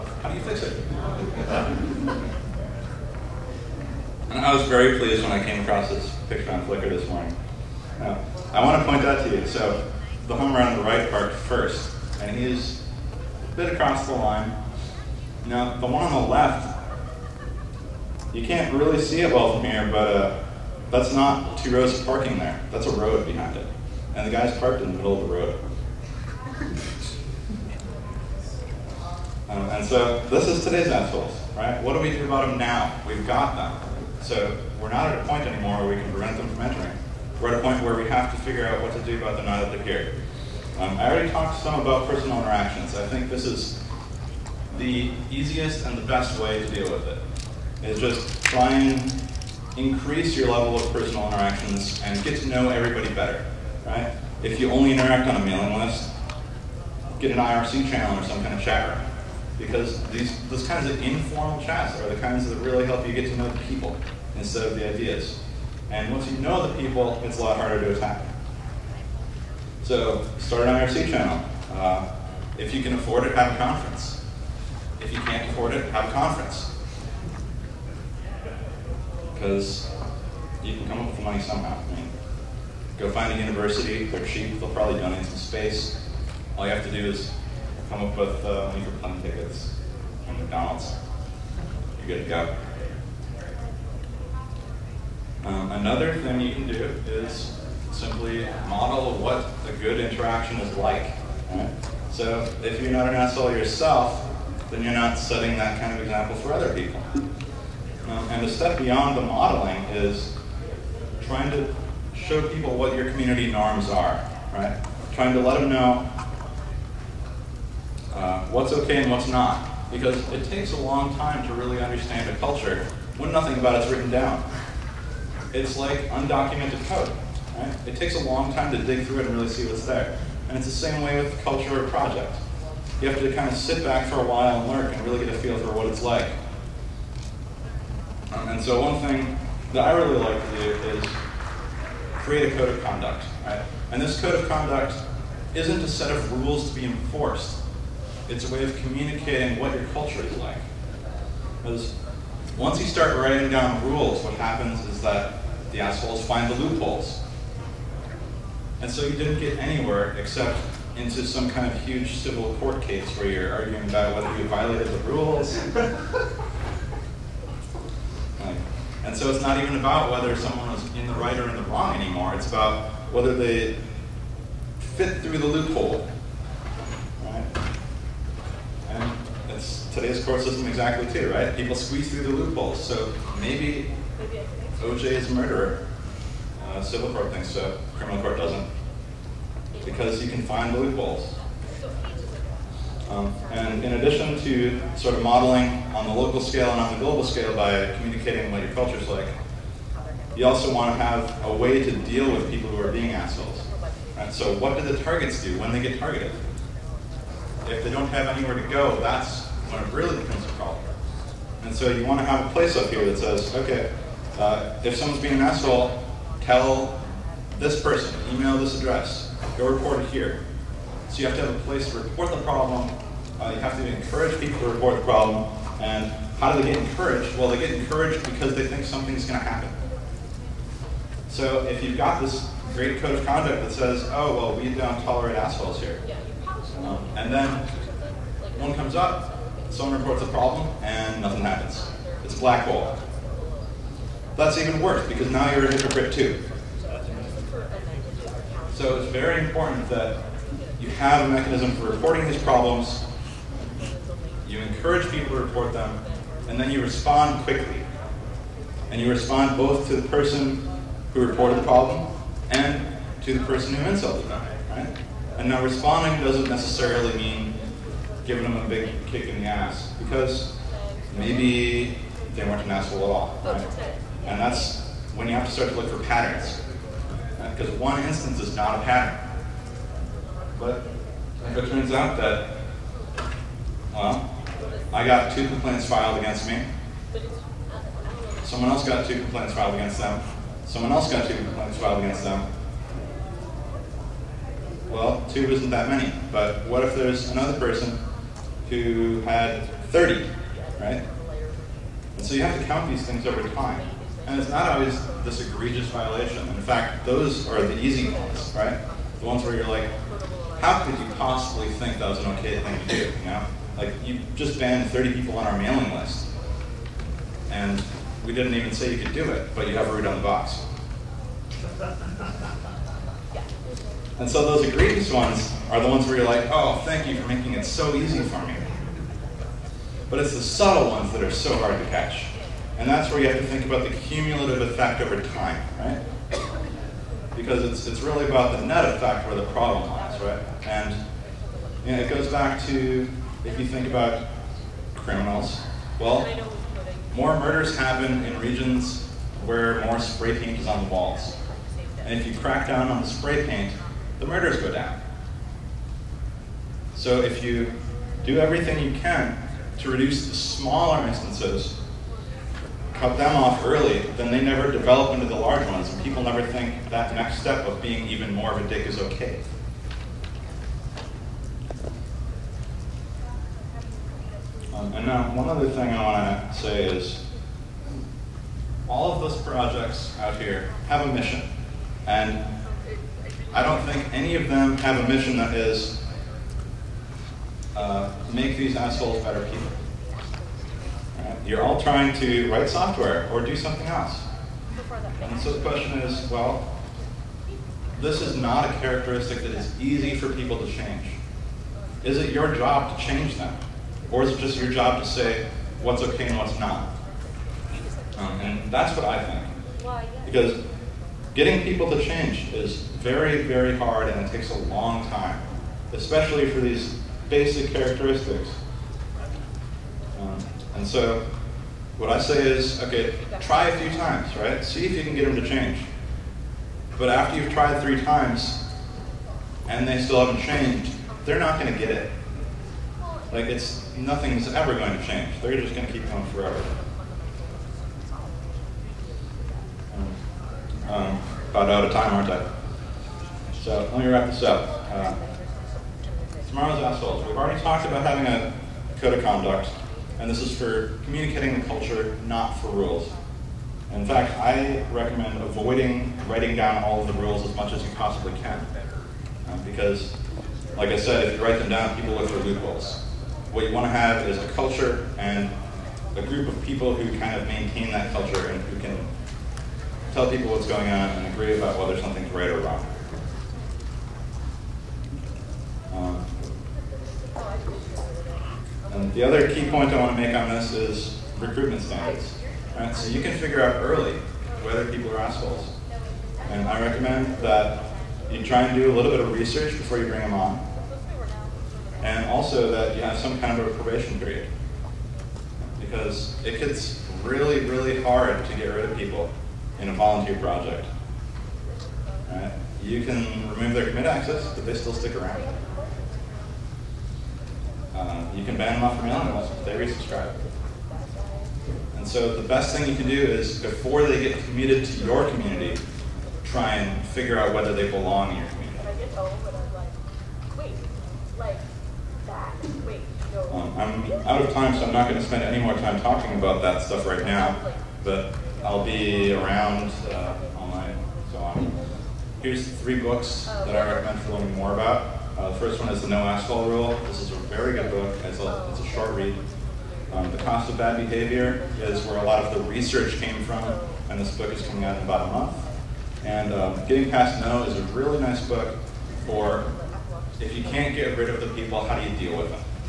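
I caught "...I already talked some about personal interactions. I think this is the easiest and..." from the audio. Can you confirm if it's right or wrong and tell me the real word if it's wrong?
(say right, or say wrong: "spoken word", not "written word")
right.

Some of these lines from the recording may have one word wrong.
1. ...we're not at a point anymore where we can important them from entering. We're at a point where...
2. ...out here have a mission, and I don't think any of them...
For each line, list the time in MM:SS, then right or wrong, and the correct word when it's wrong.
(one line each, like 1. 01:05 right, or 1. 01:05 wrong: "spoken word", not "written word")
1. 00:34 wrong: "prevent", not "important"
2. 06:20 right.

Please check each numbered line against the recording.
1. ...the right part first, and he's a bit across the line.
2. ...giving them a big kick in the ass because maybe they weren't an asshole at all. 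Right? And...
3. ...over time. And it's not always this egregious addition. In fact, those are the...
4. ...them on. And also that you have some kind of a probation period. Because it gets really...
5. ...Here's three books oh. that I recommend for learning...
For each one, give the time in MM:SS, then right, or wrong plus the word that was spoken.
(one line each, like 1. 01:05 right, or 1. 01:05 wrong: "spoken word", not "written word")
1. 00:10 right
2. 04:28 right
3. 05:03 wrong: "violation", not "addition"
4. 08:10 right
5. 08:52 right.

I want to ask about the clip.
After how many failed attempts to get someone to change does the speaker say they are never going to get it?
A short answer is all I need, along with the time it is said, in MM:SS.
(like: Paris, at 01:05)
3, at 07:07.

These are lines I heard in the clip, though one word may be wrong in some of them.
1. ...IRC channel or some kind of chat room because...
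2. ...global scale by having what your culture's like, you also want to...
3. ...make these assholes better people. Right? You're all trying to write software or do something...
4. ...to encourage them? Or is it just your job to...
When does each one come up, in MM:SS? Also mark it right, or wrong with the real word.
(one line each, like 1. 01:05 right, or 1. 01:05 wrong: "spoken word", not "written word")
1. 00:57 right
2. 03:16 wrong: "communicating", not "having"
3. 06:28 right
4. 06:42 wrong: "change", not "encourage".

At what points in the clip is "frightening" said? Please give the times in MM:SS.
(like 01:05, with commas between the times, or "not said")
not said.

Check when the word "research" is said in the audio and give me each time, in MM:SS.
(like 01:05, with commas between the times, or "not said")
08:09, 09:02.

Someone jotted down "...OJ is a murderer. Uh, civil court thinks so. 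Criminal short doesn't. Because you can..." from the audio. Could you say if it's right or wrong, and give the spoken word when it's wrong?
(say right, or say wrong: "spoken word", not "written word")
wrong: "court", not "short".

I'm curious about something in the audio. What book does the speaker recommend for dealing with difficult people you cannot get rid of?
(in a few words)
Getting Past No.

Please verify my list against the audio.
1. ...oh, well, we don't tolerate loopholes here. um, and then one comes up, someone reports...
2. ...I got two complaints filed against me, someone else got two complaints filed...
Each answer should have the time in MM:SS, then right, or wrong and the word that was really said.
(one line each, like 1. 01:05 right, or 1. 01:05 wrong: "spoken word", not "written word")
1. 03:54 wrong: "assholes", not "loopholes"
2. 04:44 right.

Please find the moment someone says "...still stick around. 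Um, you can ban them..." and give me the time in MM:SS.
08:24.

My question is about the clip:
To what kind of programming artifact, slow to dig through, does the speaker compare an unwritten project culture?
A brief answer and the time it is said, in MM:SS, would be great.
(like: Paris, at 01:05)
Undocumented code, at 02:06.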